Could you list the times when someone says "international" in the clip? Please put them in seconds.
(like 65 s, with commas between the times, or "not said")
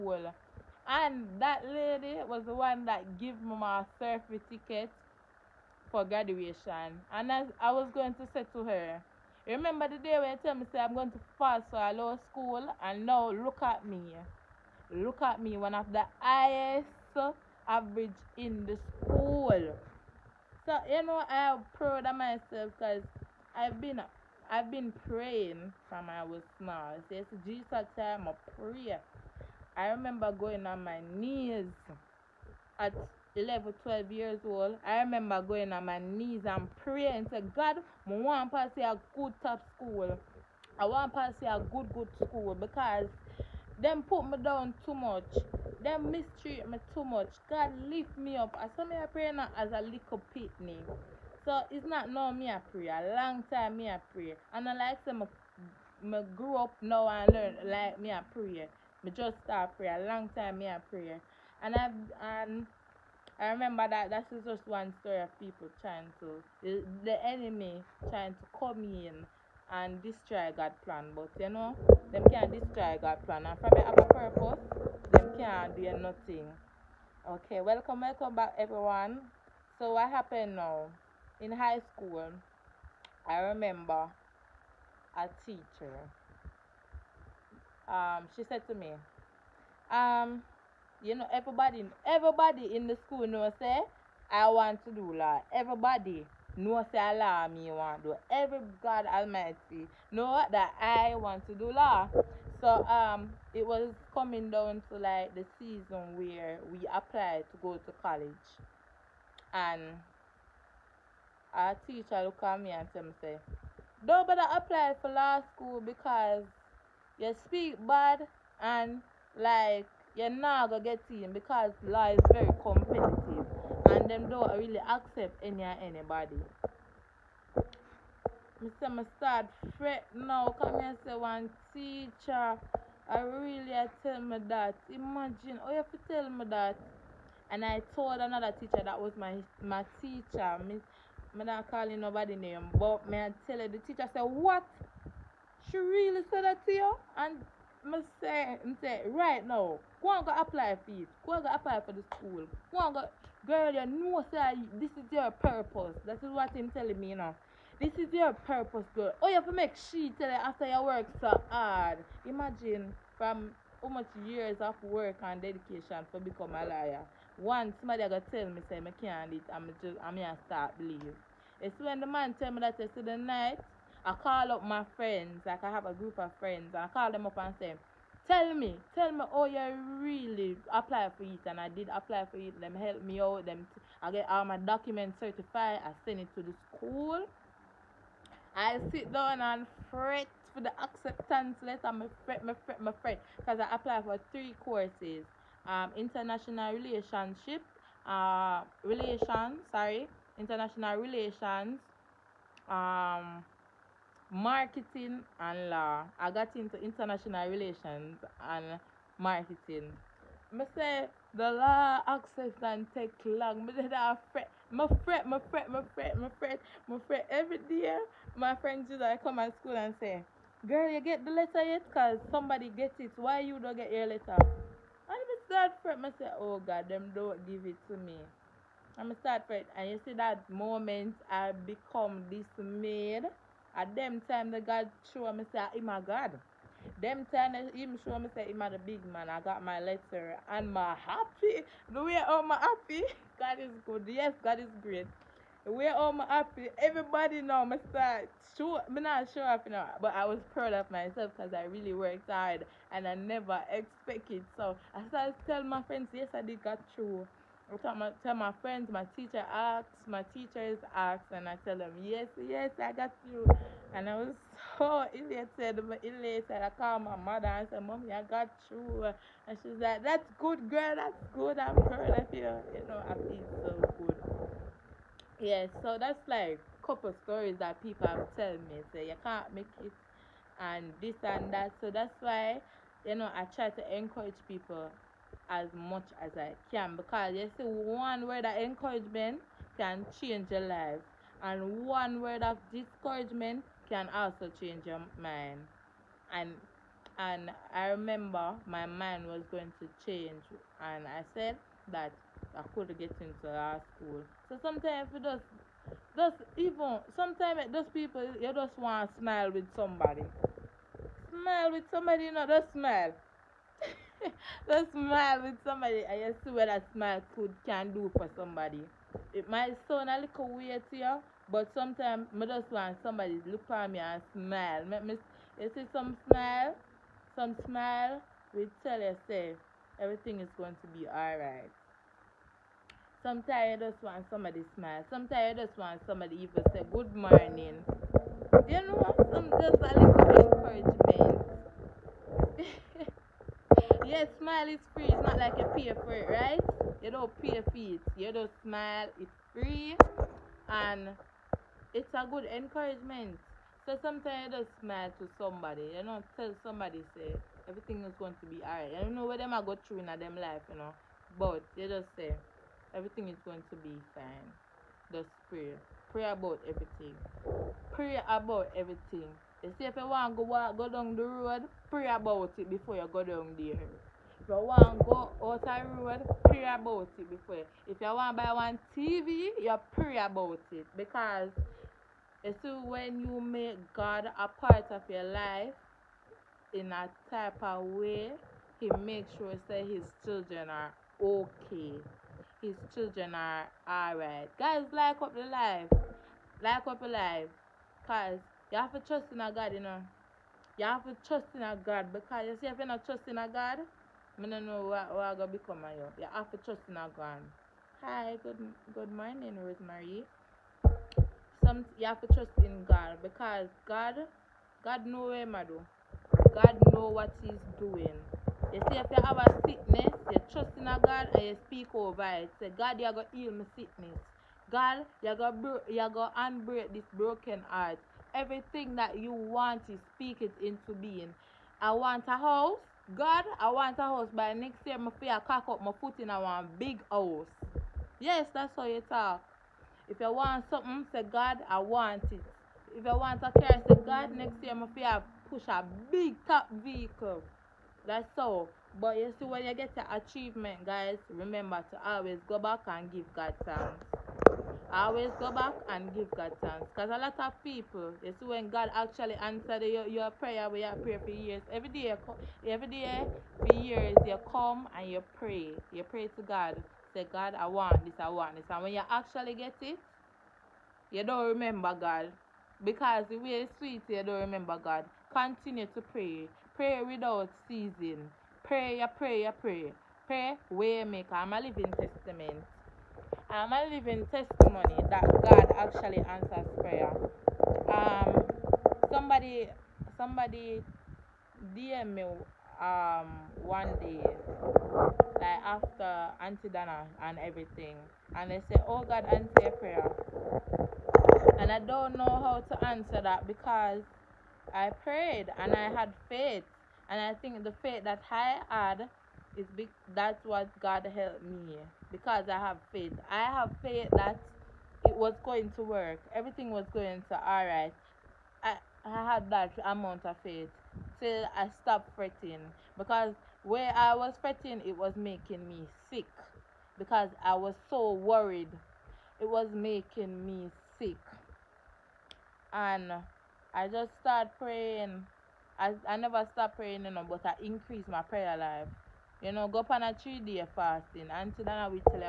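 195 s, 200 s, 206 s.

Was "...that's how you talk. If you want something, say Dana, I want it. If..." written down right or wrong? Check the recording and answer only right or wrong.
wrong.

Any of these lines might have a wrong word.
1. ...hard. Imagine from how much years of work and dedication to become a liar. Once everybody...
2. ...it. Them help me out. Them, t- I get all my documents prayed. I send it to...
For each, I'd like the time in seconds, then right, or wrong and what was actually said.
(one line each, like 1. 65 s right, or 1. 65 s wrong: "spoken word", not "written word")
1. 161 s wrong: "somebody", not "everybody"
2. 182 s wrong: "certified", not "prayed".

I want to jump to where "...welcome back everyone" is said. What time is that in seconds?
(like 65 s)
77 s.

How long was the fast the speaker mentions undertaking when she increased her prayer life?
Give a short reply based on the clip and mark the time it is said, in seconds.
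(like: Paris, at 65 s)
3 days, at 540 s.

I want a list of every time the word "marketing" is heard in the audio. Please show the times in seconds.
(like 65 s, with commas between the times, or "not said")
204 s, 209 s.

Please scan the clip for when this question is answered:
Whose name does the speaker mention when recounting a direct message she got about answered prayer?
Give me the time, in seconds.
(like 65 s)
496 s.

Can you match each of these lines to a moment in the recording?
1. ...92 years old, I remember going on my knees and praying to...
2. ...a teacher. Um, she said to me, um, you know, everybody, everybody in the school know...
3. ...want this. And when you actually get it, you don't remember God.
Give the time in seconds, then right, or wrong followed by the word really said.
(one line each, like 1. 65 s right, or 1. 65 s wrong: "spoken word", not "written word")
1. 33 s wrong: "12", not "92"
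2. 85 s right
3. 468 s right.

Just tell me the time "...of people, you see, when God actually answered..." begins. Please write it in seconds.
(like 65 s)
457 s.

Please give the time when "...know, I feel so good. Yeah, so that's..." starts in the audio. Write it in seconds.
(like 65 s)
272 s.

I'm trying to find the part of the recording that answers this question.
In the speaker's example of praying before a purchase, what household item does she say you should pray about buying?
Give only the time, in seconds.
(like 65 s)
378 s.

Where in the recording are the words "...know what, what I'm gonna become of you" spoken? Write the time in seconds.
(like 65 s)
404 s.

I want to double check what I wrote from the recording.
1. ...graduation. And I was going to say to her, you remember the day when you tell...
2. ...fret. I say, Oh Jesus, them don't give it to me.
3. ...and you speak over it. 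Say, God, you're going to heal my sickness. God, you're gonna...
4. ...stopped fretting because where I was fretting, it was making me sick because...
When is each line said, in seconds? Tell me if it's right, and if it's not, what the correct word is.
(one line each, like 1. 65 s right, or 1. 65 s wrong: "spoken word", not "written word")
1. 6 s right
2. 225 s wrong: "God", not "Jesus"
3. 421 s right
4. 521 s right.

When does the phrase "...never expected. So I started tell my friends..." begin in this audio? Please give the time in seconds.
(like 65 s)
253 s.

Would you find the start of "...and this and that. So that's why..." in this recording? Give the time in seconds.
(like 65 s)
280 s.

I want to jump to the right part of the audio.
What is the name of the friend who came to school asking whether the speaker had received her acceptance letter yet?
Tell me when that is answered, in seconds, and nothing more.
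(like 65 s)
218 s.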